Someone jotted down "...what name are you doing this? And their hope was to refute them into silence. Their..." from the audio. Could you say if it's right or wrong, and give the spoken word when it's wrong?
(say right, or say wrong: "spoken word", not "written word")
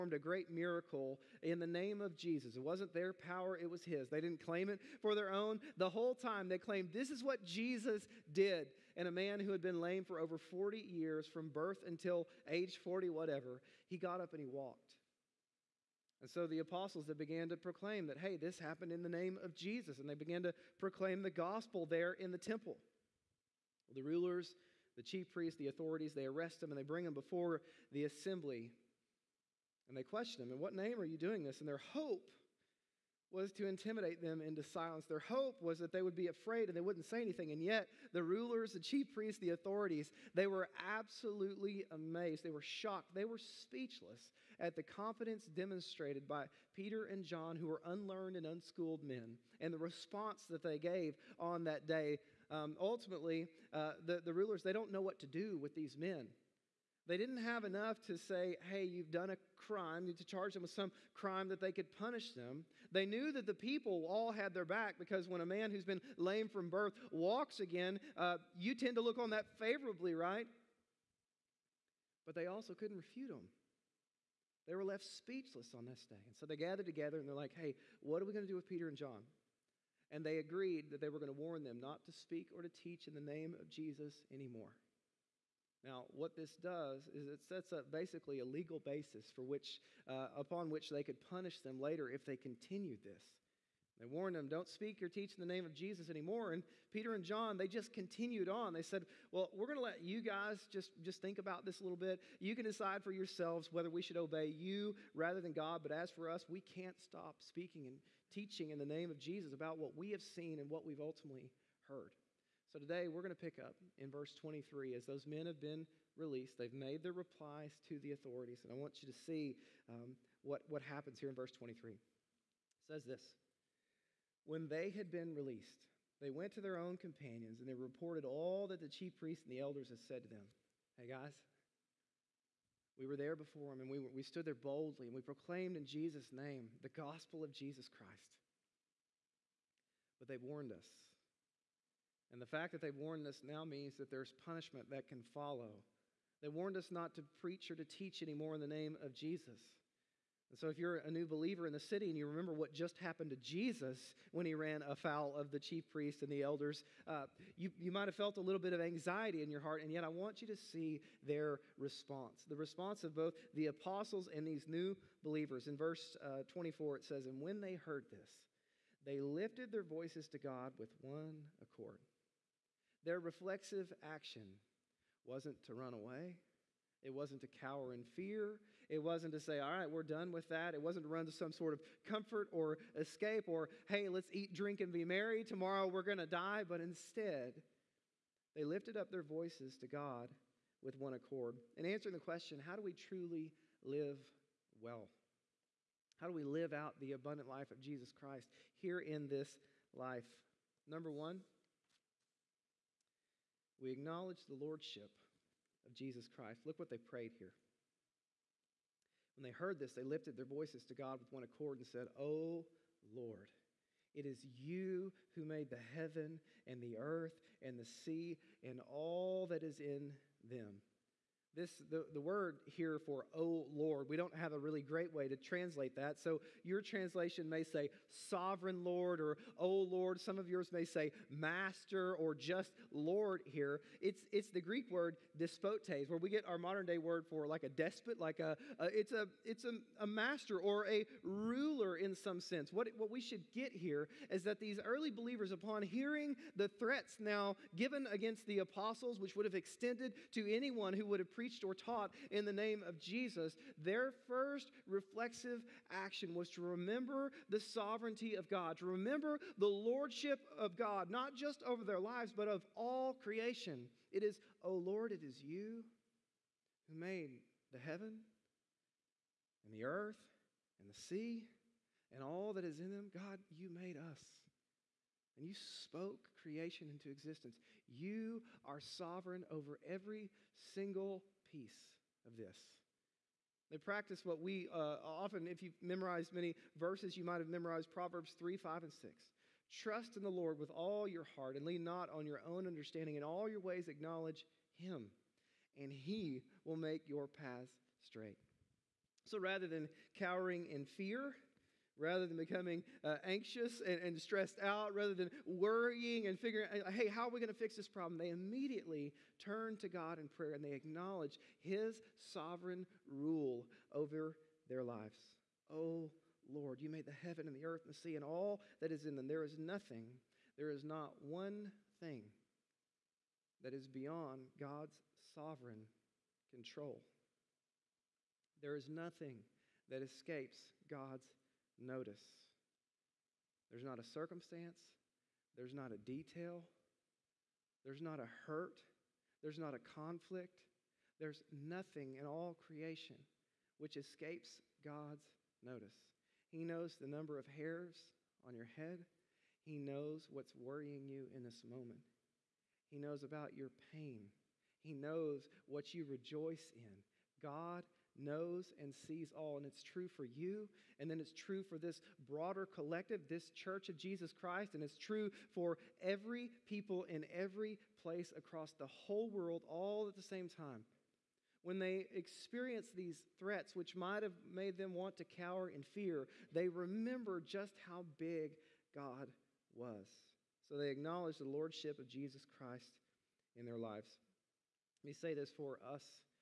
wrong: "intimidate", not "refute".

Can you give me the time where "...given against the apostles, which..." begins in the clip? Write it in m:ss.
4:07.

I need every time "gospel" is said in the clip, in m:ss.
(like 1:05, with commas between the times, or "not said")
0:21, 2:17.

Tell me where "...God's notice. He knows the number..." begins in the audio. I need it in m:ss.
5:44.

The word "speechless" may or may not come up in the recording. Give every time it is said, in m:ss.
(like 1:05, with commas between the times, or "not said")
0:43, 1:15.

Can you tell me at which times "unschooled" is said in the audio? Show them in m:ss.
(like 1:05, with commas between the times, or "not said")
0:48.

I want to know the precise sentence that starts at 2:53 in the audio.
Their reflexive action wasn't to run away, it wasn't to cower in fear.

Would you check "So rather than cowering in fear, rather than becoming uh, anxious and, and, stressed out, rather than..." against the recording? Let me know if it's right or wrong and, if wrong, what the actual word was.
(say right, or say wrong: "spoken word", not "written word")
right.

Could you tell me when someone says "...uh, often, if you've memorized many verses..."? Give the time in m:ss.
4:44.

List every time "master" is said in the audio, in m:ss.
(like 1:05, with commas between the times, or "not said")
3:51, 4:00.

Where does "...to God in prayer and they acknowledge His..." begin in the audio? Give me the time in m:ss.
5:09.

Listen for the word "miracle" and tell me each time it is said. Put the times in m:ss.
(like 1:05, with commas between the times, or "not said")
0:00.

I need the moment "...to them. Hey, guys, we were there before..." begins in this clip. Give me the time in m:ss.
2:10.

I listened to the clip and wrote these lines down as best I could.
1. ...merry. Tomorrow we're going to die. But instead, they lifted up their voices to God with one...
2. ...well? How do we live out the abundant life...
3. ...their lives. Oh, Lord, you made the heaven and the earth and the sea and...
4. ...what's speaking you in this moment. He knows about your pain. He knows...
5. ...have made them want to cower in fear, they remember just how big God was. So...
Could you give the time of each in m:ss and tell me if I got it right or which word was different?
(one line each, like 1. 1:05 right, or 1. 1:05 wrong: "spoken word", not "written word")
1. 3:05 right
2. 3:14 right
3. 5:14 right
4. 5:50 wrong: "worrying", not "speaking"
5. 6:14 right.